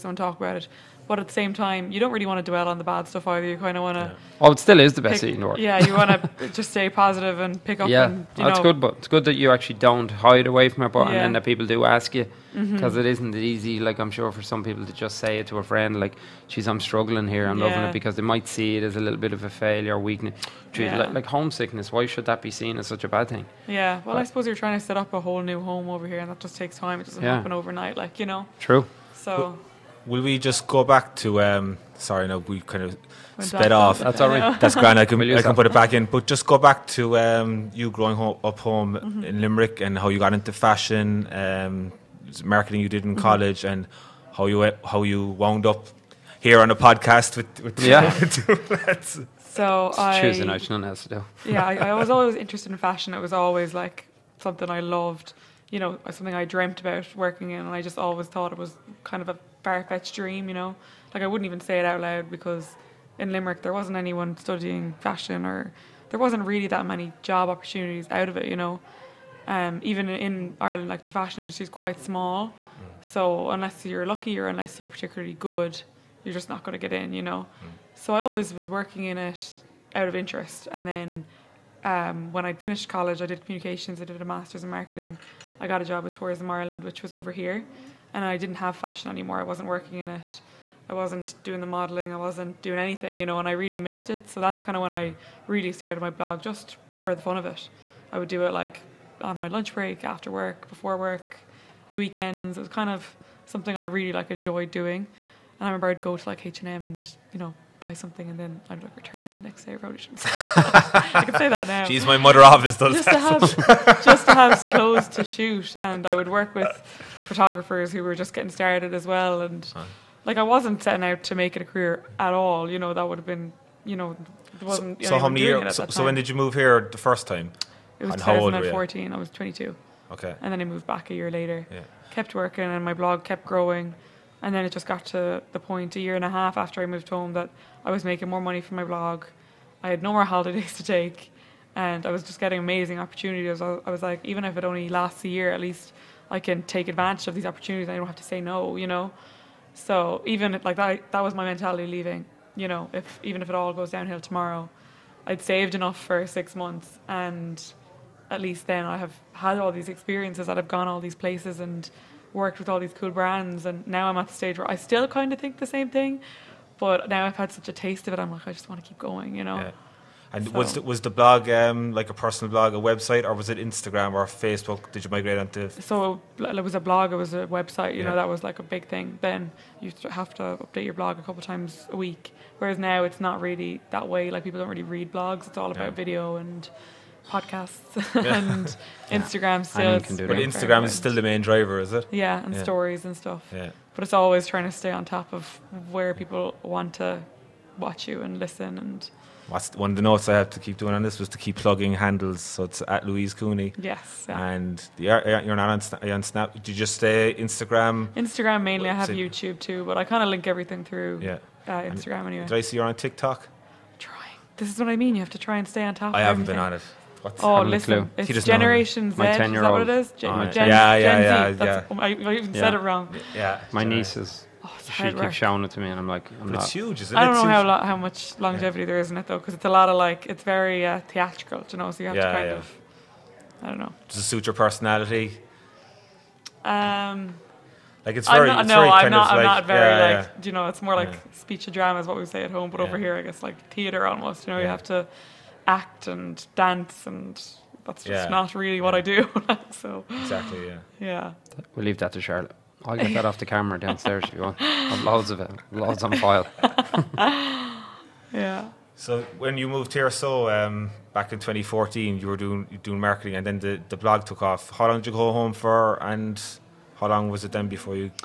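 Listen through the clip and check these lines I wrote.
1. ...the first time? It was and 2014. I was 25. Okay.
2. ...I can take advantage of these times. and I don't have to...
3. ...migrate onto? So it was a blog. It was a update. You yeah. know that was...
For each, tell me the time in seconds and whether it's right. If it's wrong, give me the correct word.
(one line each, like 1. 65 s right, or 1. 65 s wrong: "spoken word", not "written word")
1. 126 s wrong: "22", not "25"
2. 146 s wrong: "opportunities", not "times"
3. 175 s wrong: "website", not "update".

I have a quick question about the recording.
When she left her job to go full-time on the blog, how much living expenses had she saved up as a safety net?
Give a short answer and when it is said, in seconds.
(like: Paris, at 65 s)
6 months, at 156 s.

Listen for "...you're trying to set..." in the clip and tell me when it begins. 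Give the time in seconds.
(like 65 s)
24 s.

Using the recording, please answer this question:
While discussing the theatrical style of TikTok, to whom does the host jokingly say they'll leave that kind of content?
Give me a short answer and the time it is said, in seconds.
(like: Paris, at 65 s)
Charlotte, at 252 s.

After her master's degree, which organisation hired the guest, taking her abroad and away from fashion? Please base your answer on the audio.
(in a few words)
Tourism Ireland.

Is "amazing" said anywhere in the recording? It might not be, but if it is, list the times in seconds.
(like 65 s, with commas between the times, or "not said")
142 s.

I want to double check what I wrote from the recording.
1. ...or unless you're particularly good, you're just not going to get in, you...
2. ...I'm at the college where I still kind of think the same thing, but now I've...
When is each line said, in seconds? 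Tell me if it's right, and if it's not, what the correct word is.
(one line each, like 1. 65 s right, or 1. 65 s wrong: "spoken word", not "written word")
1. 74 s right
2. 164 s wrong: "stage", not "college".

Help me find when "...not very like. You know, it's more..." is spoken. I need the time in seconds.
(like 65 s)
239 s.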